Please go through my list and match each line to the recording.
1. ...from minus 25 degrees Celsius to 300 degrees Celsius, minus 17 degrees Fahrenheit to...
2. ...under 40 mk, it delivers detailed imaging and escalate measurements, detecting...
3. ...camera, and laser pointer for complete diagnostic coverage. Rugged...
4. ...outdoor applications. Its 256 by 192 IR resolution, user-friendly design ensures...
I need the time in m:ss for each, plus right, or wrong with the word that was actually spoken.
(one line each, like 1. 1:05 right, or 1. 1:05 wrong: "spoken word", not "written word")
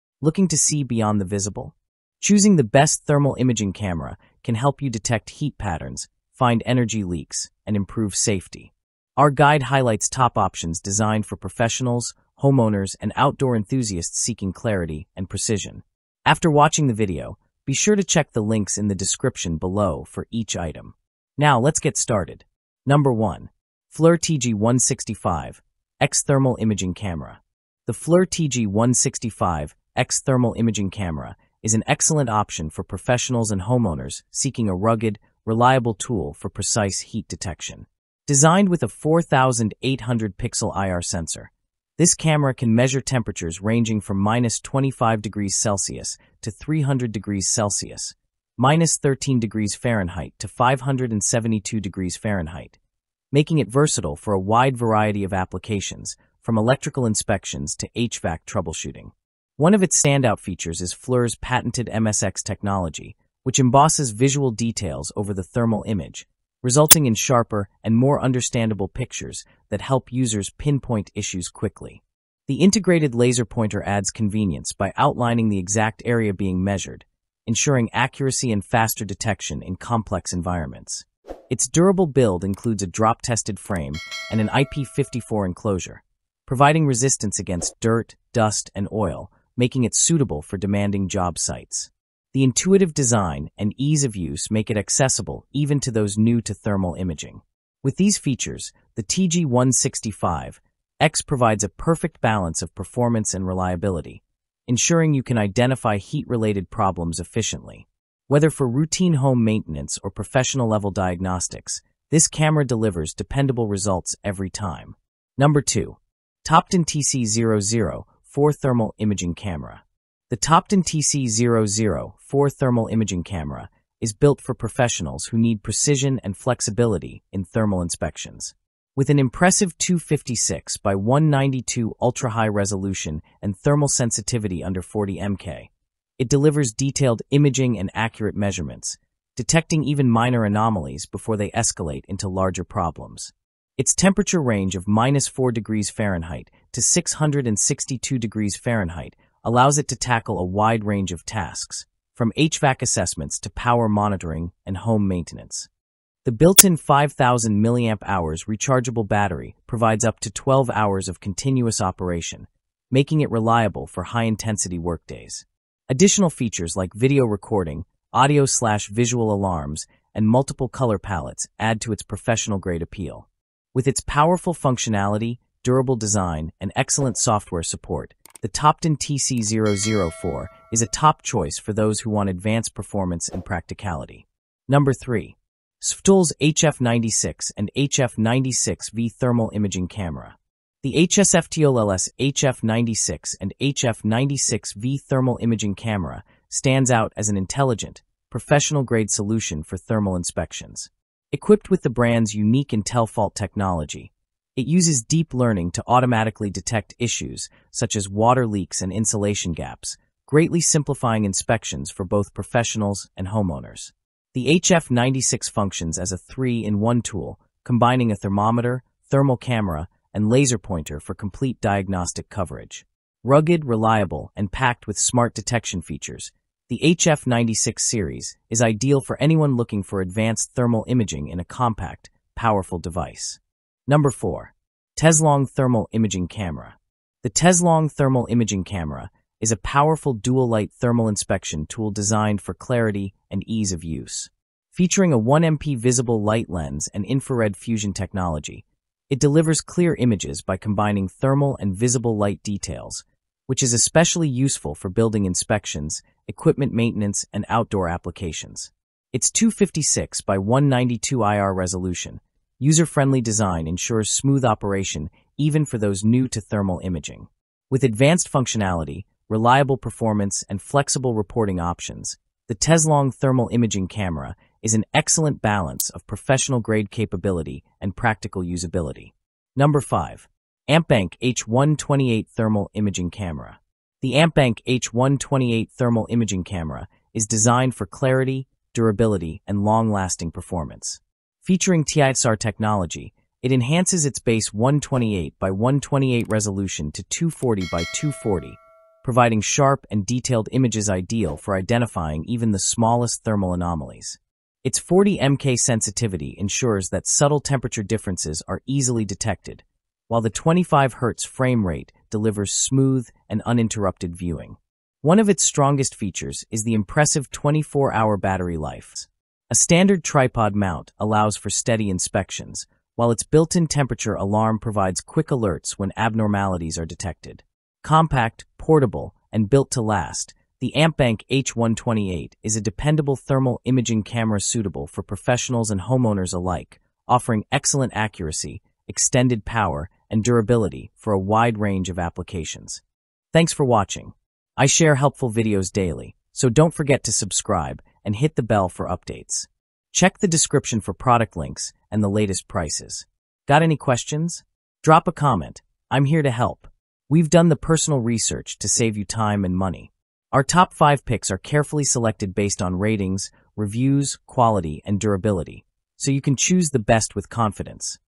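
1. 0:43 wrong: "13", not "17"
2. 2:14 wrong: "accurate", not "escalate"
3. 3:39 right
4. 4:17 right.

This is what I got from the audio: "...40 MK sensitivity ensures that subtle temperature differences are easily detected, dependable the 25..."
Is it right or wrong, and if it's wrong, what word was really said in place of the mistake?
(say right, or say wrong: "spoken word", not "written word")
wrong: "while", not "dependable".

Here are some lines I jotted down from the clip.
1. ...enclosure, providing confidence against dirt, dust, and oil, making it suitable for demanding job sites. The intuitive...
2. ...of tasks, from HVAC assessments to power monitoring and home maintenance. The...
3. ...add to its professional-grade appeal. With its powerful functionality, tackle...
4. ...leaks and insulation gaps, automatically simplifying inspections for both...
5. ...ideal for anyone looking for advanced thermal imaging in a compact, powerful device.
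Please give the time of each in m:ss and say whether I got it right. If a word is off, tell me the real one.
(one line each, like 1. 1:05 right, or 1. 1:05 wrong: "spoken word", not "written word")
1. 1:25 wrong: "resistance", not "confidence"
2. 2:31 right
3. 2:51 wrong: "durable", not "tackle"
4. 3:28 wrong: "greatly", not "automatically"
5. 3:48 right.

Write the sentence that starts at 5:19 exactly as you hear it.
A standard tripod mount allows for steady inspections, while its built-in temperature alarm provides quick alerts when abnormalities are detected.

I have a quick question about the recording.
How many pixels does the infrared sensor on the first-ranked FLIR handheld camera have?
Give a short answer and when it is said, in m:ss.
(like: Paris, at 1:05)
4,800, at 0:38.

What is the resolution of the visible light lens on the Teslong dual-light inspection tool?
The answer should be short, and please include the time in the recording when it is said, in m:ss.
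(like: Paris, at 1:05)
1MP, at 4:05.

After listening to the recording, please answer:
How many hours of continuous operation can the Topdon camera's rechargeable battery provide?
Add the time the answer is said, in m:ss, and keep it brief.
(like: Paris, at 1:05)
12 hours, at 2:40.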